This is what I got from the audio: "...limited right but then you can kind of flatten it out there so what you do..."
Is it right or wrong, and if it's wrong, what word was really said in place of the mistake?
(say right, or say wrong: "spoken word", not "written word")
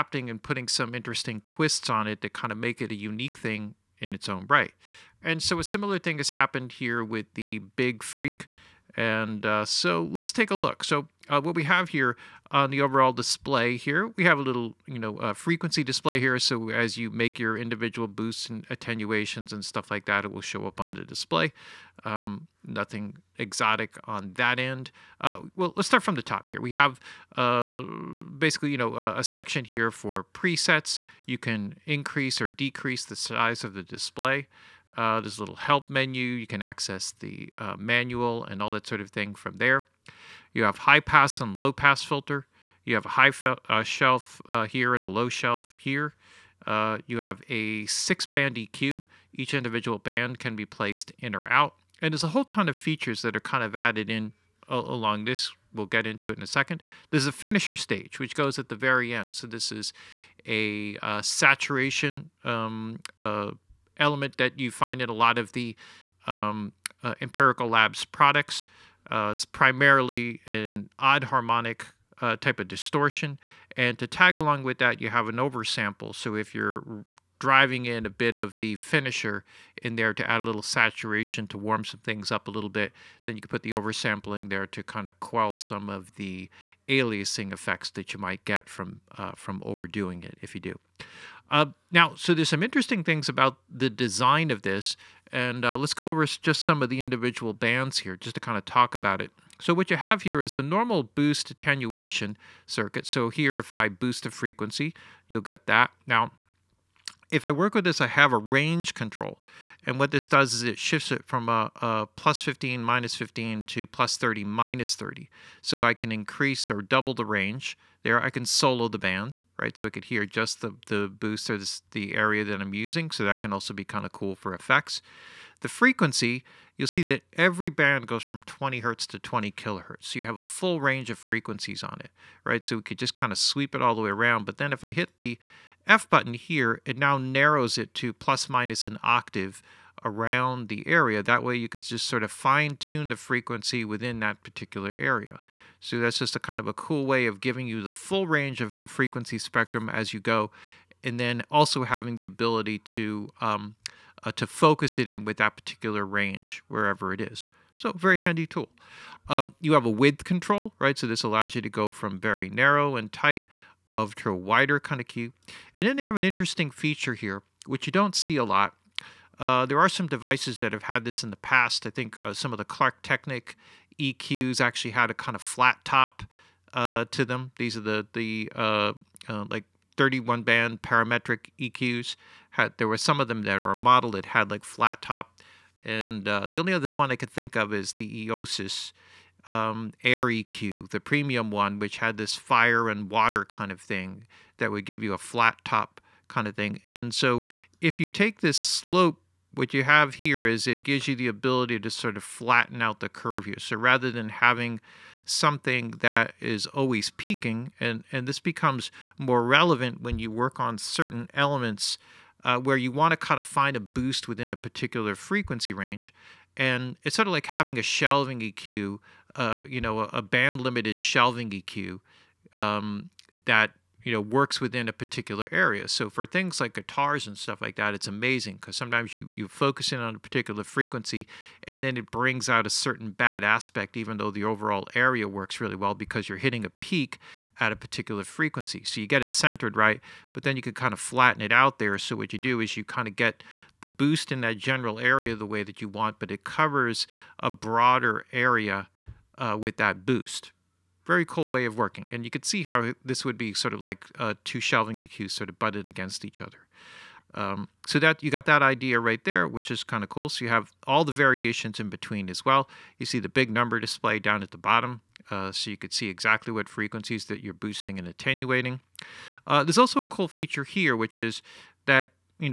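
wrong: "centered", not "limited".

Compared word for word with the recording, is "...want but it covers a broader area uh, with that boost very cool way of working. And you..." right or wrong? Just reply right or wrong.
right.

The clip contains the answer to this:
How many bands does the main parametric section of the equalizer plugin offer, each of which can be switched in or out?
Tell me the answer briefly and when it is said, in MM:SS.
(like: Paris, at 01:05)
6, at 00:47.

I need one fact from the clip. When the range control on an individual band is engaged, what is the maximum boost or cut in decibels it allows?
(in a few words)
30.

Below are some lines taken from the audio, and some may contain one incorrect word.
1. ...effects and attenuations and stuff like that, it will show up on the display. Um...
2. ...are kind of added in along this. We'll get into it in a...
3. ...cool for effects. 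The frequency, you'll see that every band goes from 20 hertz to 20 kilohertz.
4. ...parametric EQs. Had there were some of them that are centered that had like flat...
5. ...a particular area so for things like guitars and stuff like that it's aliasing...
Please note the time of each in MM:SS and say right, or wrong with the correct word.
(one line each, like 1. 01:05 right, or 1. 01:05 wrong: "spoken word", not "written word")
1. 00:18 wrong: "boosts", not "effects"
2. 00:53 right
3. 02:04 right
4. 03:00 wrong: "modeled", not "centered"
5. 03:44 wrong: "amazing", not "aliasing".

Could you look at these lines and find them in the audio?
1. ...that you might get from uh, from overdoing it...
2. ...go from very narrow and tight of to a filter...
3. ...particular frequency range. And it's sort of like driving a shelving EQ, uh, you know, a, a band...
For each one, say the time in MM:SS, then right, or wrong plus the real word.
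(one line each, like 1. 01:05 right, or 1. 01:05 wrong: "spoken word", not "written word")
1. 01:27 right
2. 02:41 wrong: "wider", not "filter"
3. 03:34 wrong: "having", not "driving".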